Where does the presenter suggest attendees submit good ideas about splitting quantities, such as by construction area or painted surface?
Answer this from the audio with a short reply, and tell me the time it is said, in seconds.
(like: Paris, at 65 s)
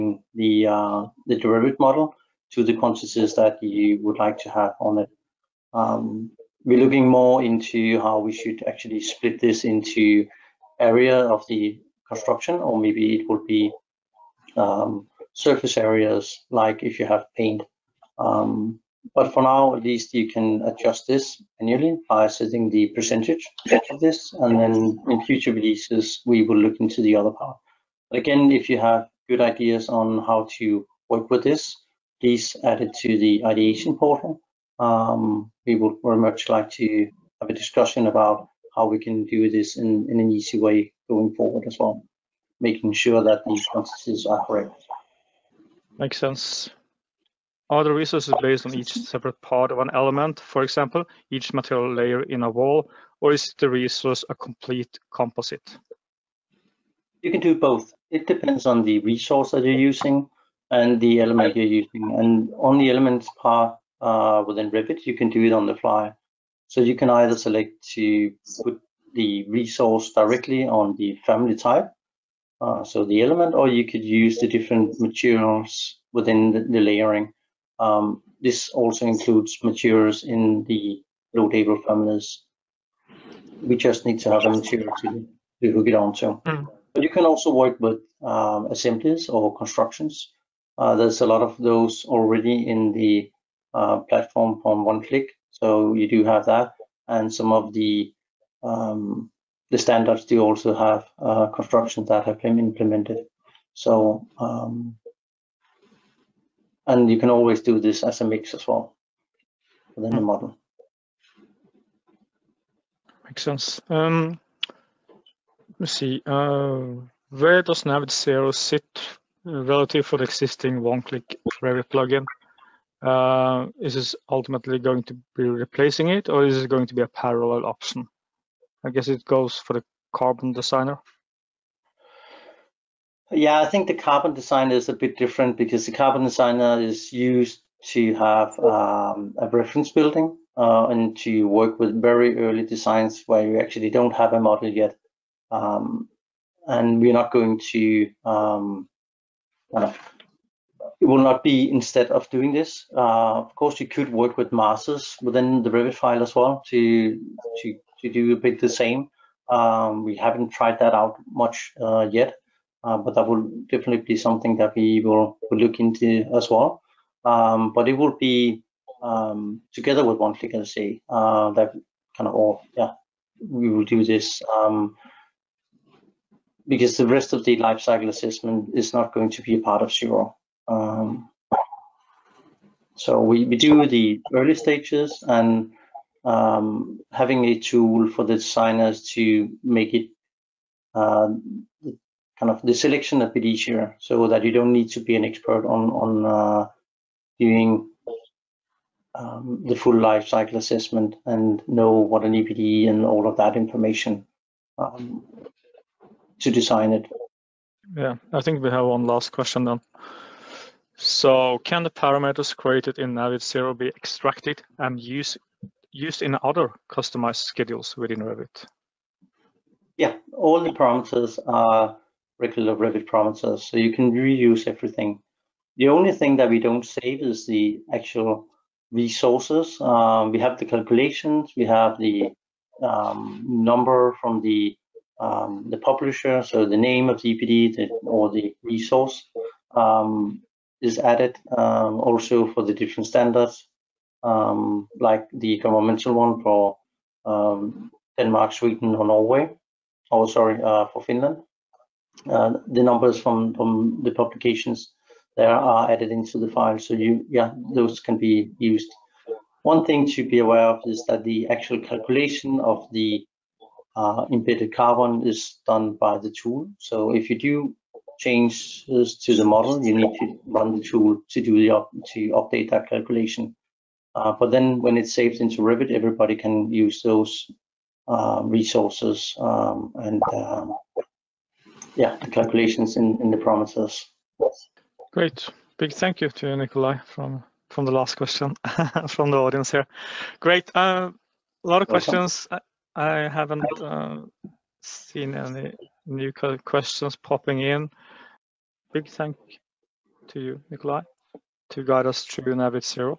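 The ideation portal, at 33 s.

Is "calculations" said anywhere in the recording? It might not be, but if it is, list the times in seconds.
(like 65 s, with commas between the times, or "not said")
230 s, 261 s, 272 s, 282 s.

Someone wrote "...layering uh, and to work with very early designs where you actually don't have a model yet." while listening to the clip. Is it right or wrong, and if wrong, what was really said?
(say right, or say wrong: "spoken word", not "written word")
wrong: "building", not "layering".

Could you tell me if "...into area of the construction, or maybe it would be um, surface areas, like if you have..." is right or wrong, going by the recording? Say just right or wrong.
right.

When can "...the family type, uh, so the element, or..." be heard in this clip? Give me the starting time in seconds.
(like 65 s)
70 s.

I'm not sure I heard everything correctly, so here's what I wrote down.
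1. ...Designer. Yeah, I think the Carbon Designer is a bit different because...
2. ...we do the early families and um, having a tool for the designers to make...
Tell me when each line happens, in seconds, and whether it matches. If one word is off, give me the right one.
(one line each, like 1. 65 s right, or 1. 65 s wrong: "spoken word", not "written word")
1. 130 s right
2. 183 s wrong: "stages", not "families".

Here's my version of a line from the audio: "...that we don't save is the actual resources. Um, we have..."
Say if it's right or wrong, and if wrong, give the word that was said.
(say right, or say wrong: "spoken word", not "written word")
right.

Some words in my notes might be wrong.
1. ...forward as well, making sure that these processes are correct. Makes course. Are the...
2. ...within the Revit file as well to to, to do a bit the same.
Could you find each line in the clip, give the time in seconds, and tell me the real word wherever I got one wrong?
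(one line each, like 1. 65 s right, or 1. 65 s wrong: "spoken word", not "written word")
1. 41 s wrong: "sense", not "course"
2. 155 s right.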